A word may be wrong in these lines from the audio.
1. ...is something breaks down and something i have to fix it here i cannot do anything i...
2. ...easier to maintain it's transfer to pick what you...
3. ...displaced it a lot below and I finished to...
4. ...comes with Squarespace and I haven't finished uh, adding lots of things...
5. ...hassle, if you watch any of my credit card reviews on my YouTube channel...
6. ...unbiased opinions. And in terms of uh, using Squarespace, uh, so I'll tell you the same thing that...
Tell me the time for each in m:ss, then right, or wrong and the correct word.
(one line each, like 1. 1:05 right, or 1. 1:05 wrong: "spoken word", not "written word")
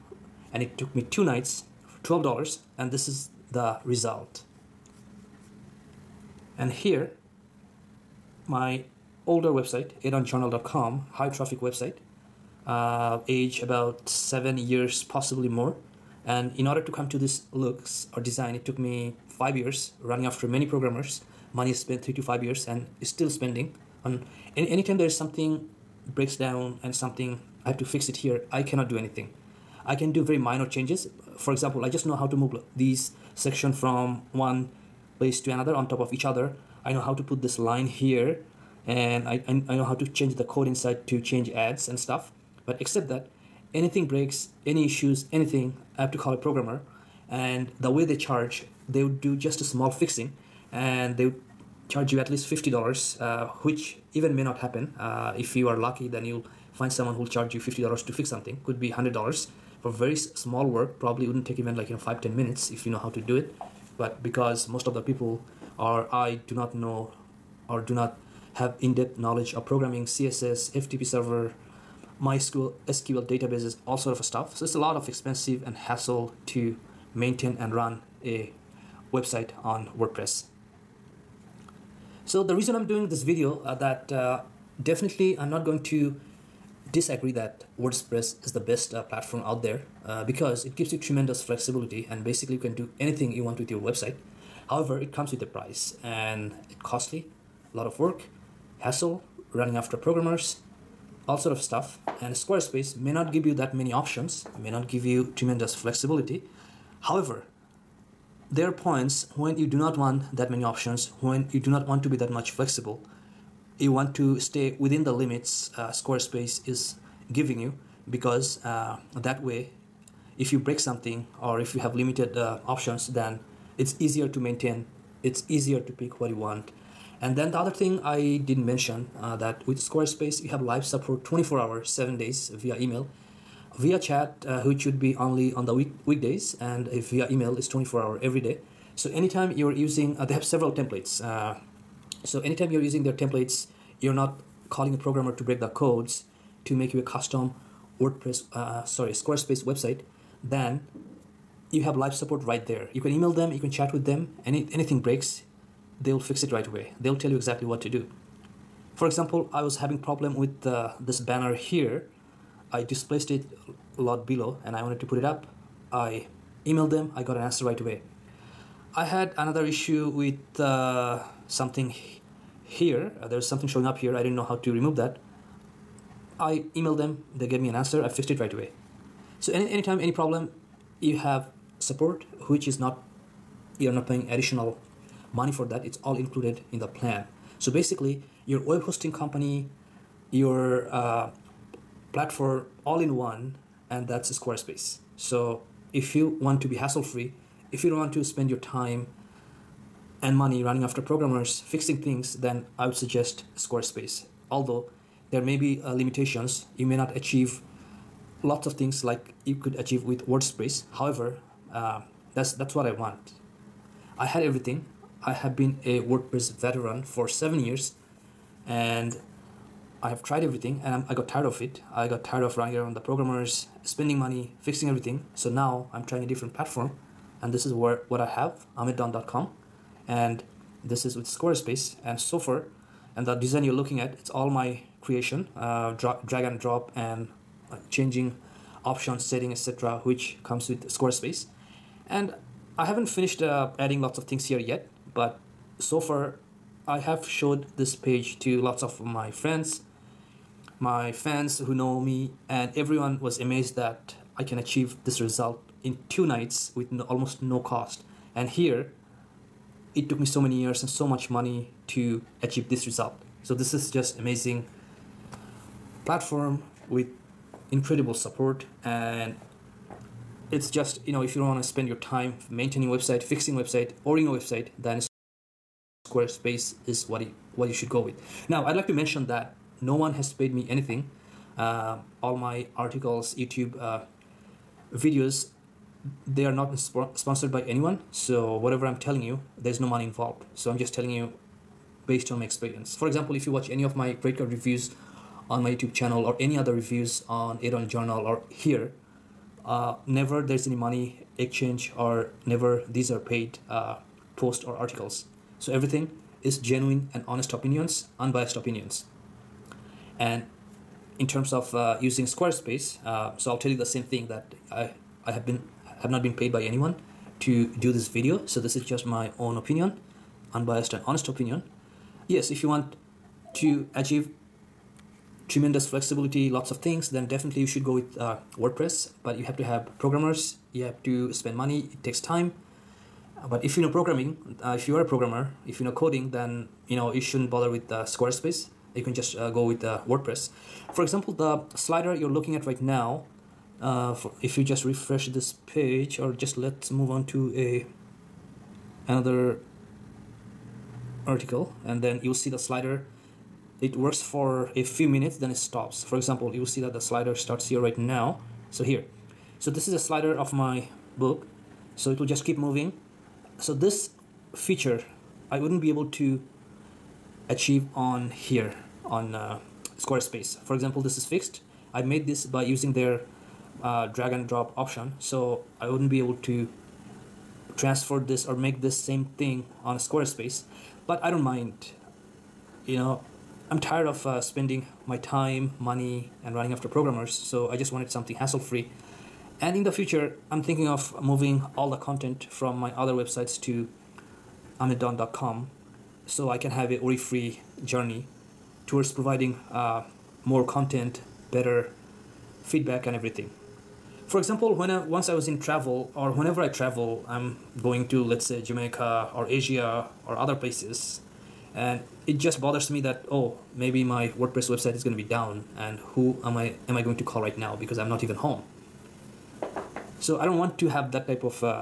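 1. 0:25 right
2. 2:03 wrong: "easier", not "transfer"
3. 2:42 wrong: "wanted", not "finished"
4. 4:00 right
5. 4:53 wrong: "example", not "hassle"
6. 5:08 right.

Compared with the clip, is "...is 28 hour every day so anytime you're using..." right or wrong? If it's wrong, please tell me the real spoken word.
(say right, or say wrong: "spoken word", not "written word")
wrong: "24", not "28".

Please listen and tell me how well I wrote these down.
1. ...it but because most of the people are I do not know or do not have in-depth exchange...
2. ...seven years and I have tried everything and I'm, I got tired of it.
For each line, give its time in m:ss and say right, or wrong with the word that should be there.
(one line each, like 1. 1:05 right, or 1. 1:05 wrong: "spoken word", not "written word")
1. 1:03 wrong: "knowledge", not "exchange"
2. 3:37 right.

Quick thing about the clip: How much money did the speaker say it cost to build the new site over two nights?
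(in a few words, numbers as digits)
$12.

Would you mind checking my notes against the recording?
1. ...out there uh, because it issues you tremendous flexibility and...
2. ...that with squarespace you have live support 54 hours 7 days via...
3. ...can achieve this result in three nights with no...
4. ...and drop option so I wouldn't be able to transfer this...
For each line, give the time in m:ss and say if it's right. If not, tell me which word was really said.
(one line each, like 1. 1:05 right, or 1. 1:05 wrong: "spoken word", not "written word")
1. 1:29 wrong: "gives", not "issues"
2. 2:09 wrong: "24", not "54"
3. 4:14 wrong: "two", not "three"
4. 6:14 right.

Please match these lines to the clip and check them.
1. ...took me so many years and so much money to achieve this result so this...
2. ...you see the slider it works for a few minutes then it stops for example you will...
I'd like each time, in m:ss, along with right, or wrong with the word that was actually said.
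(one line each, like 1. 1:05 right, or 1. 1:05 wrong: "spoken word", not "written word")
1. 4:20 right
2. 5:52 right.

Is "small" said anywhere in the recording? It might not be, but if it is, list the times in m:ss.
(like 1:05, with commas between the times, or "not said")
0:49, 1:00.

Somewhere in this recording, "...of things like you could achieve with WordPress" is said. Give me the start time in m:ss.
3:28.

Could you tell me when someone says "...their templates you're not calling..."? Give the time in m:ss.
2:23.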